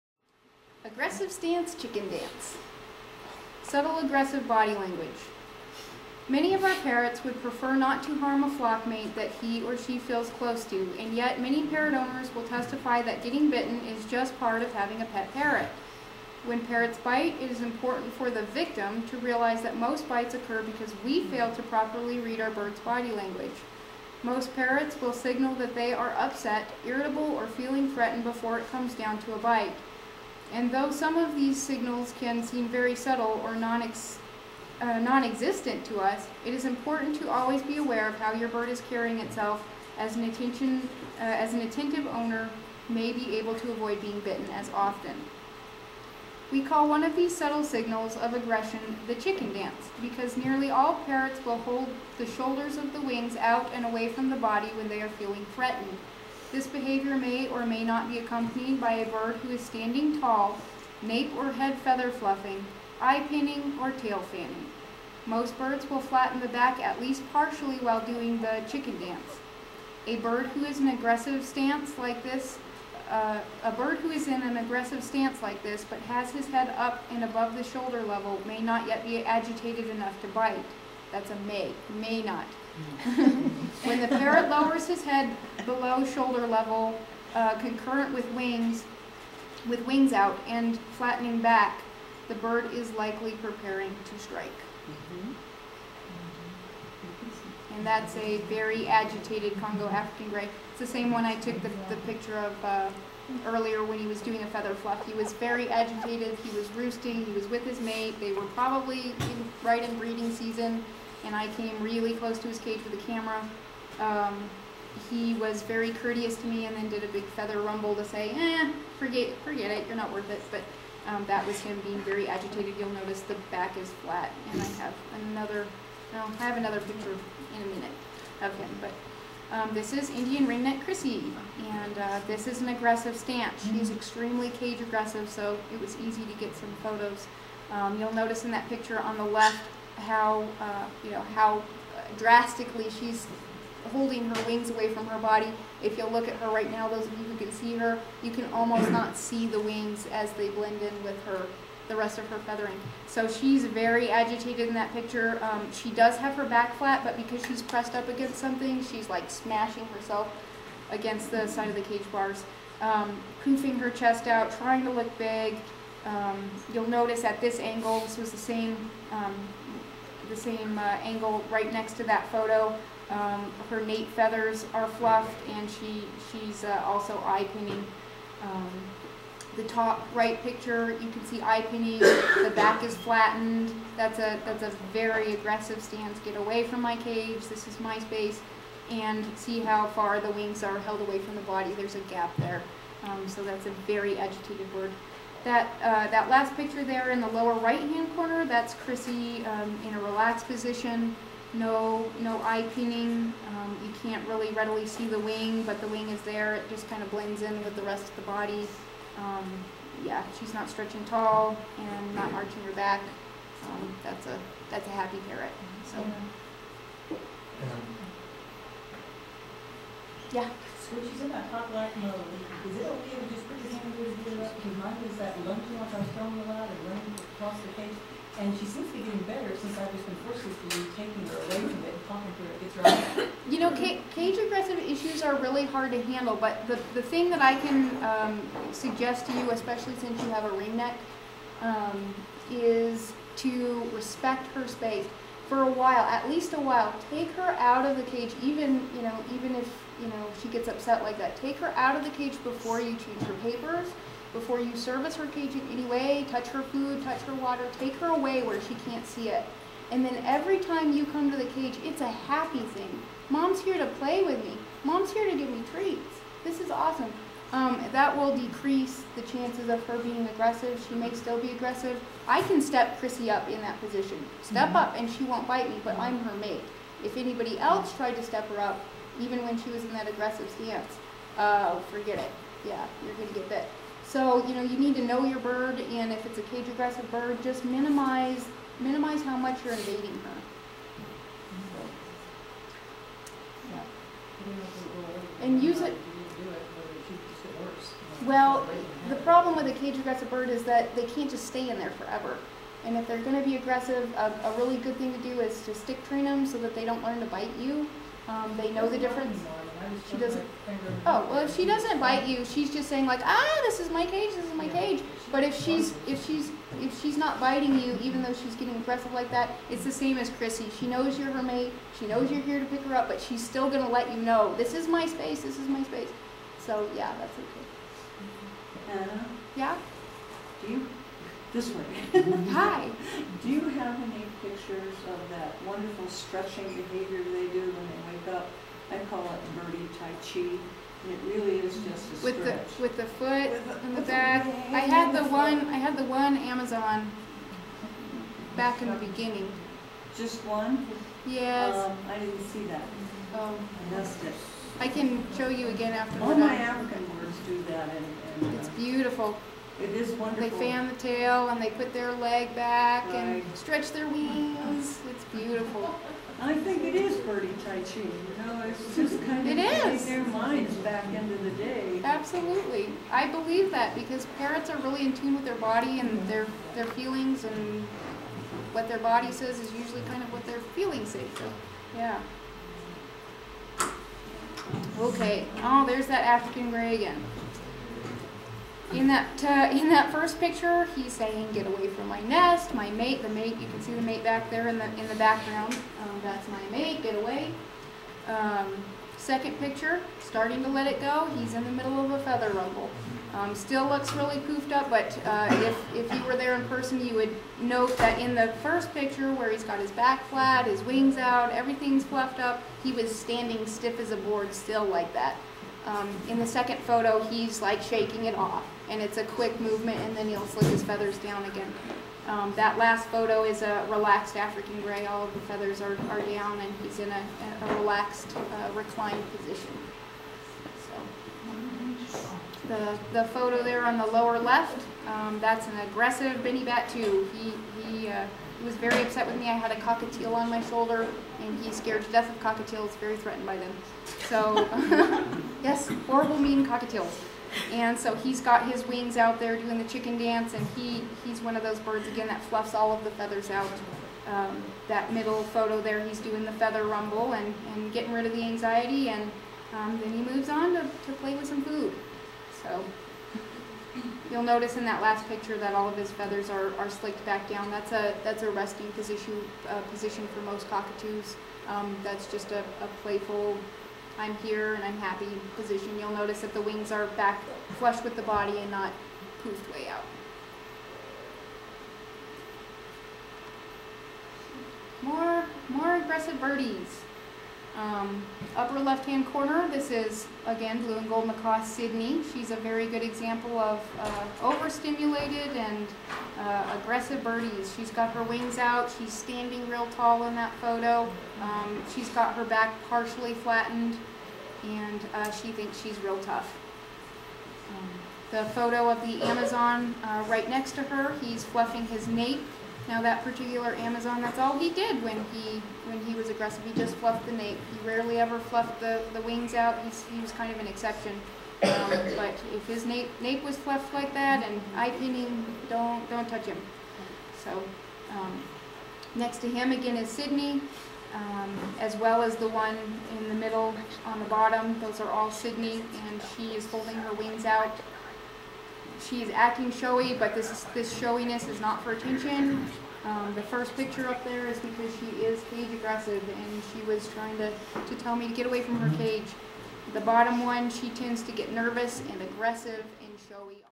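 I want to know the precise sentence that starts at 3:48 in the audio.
And she seems to be getting better since I've just been be taking her away from it and talking to her.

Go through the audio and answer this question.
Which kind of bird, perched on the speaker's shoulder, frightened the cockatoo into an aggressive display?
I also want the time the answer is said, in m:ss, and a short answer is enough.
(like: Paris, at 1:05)
cockatiel, at 7:19.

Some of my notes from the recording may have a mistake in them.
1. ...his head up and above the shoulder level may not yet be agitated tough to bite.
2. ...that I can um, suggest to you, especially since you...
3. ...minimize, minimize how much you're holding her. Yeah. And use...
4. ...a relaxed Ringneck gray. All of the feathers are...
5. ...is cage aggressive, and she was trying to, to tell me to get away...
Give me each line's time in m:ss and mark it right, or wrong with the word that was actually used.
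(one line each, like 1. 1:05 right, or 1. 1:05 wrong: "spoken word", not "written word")
1. 1:16 wrong: "enough", not "tough"
2. 3:57 right
3. 4:47 wrong: "invading", not "holding"
4. 7:03 wrong: "African", not "Ringneck"
5. 9:05 right.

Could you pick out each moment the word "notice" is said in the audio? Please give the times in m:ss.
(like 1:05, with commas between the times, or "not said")
2:02, 2:18, 2:46, 7:44, 7:56.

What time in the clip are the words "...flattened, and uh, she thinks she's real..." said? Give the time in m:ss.
8:23.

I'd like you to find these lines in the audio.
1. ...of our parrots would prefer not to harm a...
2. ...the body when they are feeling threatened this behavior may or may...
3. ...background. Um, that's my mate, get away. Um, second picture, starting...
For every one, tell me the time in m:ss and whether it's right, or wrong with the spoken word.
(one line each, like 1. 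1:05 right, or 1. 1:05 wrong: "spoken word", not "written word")
1. 0:06 right
2. 0:54 right
3. 6:35 right.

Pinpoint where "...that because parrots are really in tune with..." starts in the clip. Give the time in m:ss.
6:13.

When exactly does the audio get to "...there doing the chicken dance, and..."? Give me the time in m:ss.
7:29.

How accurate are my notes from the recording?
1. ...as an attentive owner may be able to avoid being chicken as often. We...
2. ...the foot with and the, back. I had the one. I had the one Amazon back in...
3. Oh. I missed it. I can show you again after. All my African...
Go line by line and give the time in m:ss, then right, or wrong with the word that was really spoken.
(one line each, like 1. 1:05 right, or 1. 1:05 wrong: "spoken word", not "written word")
1. 0:41 wrong: "bitten", not "chicken"
2. 5:42 right
3. 5:53 right.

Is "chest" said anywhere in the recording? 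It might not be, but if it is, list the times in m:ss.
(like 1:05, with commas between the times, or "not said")
2:43.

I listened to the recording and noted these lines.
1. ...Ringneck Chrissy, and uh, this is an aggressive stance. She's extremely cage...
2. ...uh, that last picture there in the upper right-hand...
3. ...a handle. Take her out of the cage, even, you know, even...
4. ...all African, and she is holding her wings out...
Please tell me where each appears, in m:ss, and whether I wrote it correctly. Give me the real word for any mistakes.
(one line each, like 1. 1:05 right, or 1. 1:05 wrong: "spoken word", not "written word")
1. 2:10 right
2. 3:15 wrong: "lower", not "upper"
3. 4:06 wrong: "while", not "handle"
4. 8:55 wrong: "Sydney", not "African".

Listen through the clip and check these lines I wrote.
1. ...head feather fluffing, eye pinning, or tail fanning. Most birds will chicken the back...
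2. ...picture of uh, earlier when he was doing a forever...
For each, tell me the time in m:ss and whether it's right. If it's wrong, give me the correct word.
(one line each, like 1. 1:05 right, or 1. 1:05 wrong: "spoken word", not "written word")
1. 1:01 wrong: "flatten", not "chicken"
2. 1:42 wrong: "feather", not "forever".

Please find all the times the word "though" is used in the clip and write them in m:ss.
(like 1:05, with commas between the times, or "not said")
0:30, 5:18.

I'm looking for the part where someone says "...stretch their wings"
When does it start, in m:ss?
6:03.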